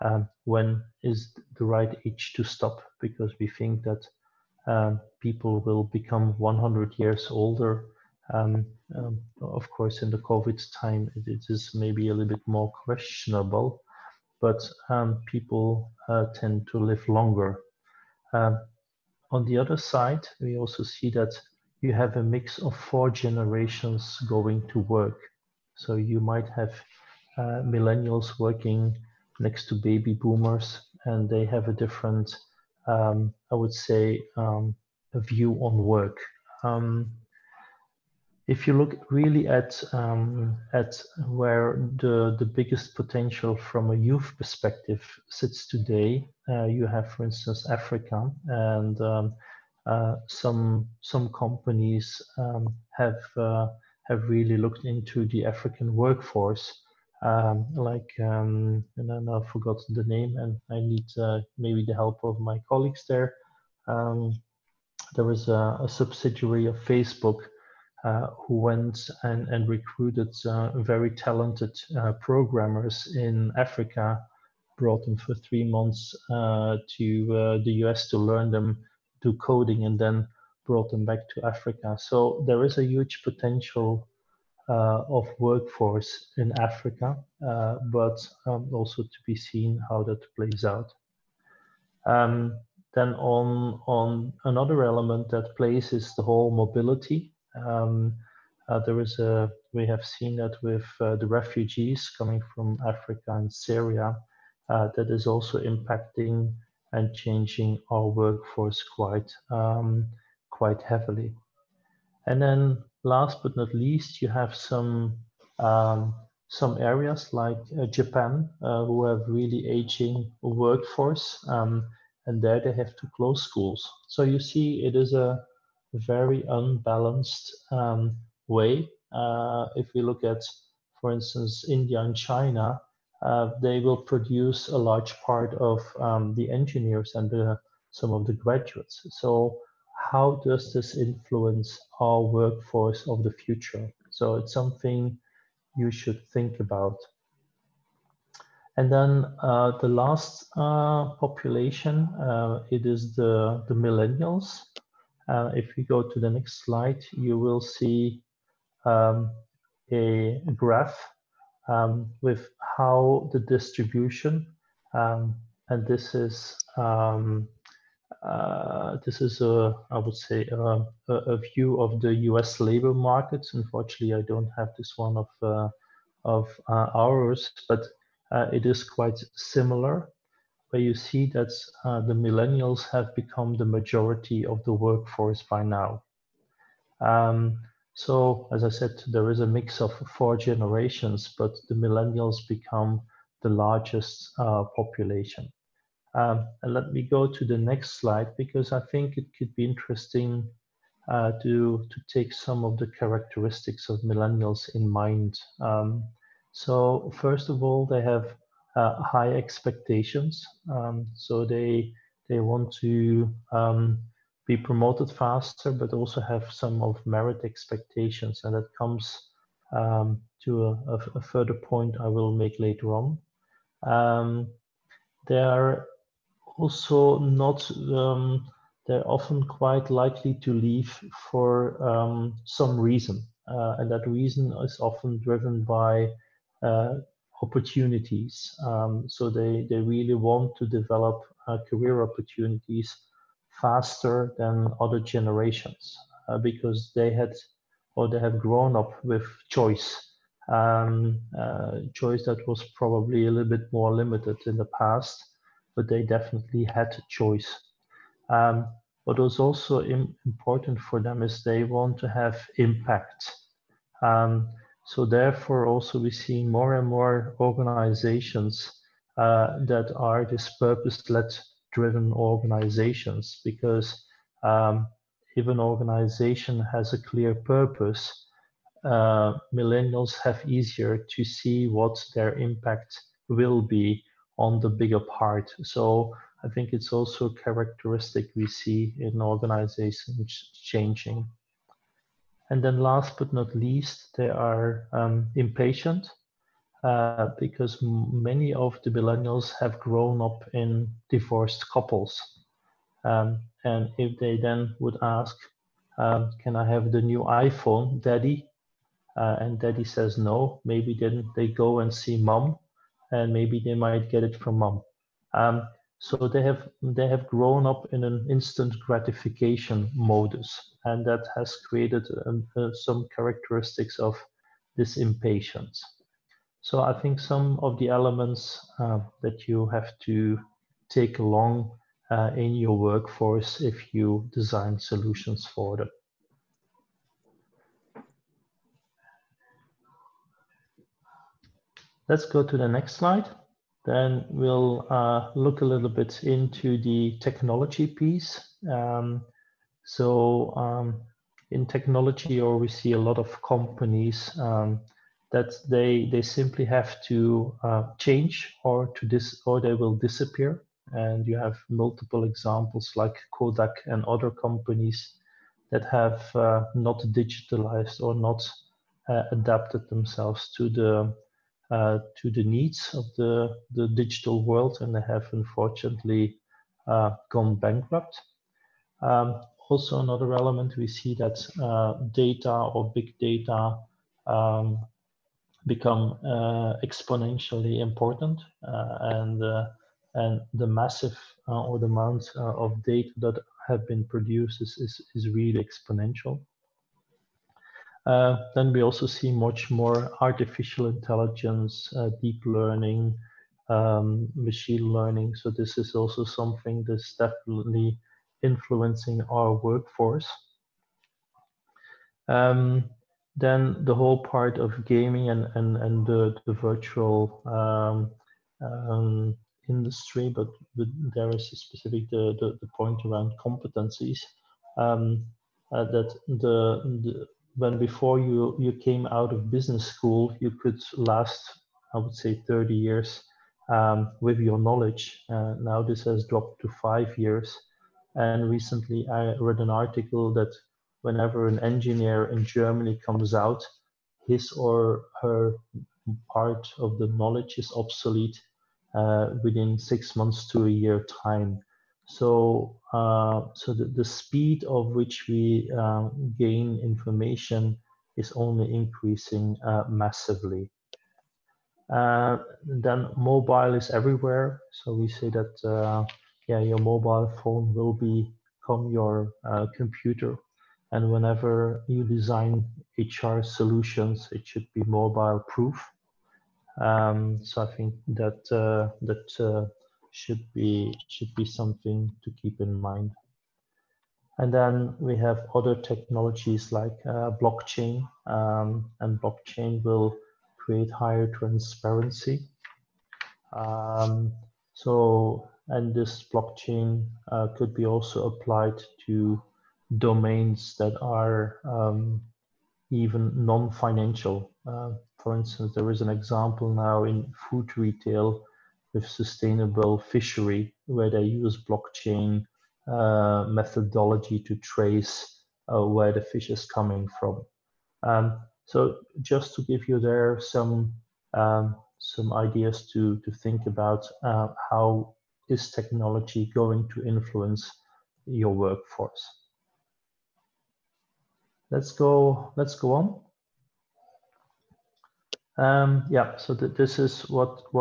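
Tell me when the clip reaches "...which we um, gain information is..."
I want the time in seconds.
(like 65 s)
454 s.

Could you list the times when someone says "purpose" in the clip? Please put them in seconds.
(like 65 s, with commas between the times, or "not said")
270 s, 277 s.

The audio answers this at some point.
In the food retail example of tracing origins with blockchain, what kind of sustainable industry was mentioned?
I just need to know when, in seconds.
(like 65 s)
509 s.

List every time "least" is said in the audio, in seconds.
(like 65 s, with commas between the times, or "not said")
113 s, 293 s.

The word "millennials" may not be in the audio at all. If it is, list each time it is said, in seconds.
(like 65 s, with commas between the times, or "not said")
27 s, 153 s, 182 s, 191 s, 204 s, 279 s, 298 s.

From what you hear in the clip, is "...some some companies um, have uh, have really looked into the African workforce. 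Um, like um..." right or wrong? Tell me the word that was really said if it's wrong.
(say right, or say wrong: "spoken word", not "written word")
right.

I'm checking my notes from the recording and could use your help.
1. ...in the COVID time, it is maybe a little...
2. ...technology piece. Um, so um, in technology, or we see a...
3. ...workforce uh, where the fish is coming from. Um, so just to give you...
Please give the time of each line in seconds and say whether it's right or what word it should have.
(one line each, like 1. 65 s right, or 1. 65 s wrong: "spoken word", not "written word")
1. 10 s right
2. 347 s right
3. 514 s wrong: "trace", not "workforce".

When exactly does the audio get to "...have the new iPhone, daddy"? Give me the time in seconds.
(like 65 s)
306 s.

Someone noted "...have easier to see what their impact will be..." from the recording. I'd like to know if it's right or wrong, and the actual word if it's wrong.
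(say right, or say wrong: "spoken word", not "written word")
right.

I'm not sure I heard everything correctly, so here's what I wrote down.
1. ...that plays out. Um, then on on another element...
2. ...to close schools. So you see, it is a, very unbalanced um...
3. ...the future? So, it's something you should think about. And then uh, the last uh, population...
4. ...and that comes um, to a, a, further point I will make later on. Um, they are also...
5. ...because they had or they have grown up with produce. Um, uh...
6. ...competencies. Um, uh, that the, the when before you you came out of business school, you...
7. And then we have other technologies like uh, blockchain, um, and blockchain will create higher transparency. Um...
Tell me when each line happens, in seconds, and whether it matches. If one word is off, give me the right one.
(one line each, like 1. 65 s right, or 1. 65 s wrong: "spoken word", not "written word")
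1. 90 s right
2. 122 s right
3. 143 s right
4. 218 s right
5. 246 s wrong: "choice", not "produce"
6. 423 s right
7. 484 s right.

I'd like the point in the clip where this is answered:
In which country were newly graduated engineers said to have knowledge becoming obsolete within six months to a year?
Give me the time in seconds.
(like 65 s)
442 s.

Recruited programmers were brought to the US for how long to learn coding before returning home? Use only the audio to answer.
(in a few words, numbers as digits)
3 months.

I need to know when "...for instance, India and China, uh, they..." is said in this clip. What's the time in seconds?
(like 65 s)
131 s.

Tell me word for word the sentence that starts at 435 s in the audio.
Uh, now this has dropped to five years.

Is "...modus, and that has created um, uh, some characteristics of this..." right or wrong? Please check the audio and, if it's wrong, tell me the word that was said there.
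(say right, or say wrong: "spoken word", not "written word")
right.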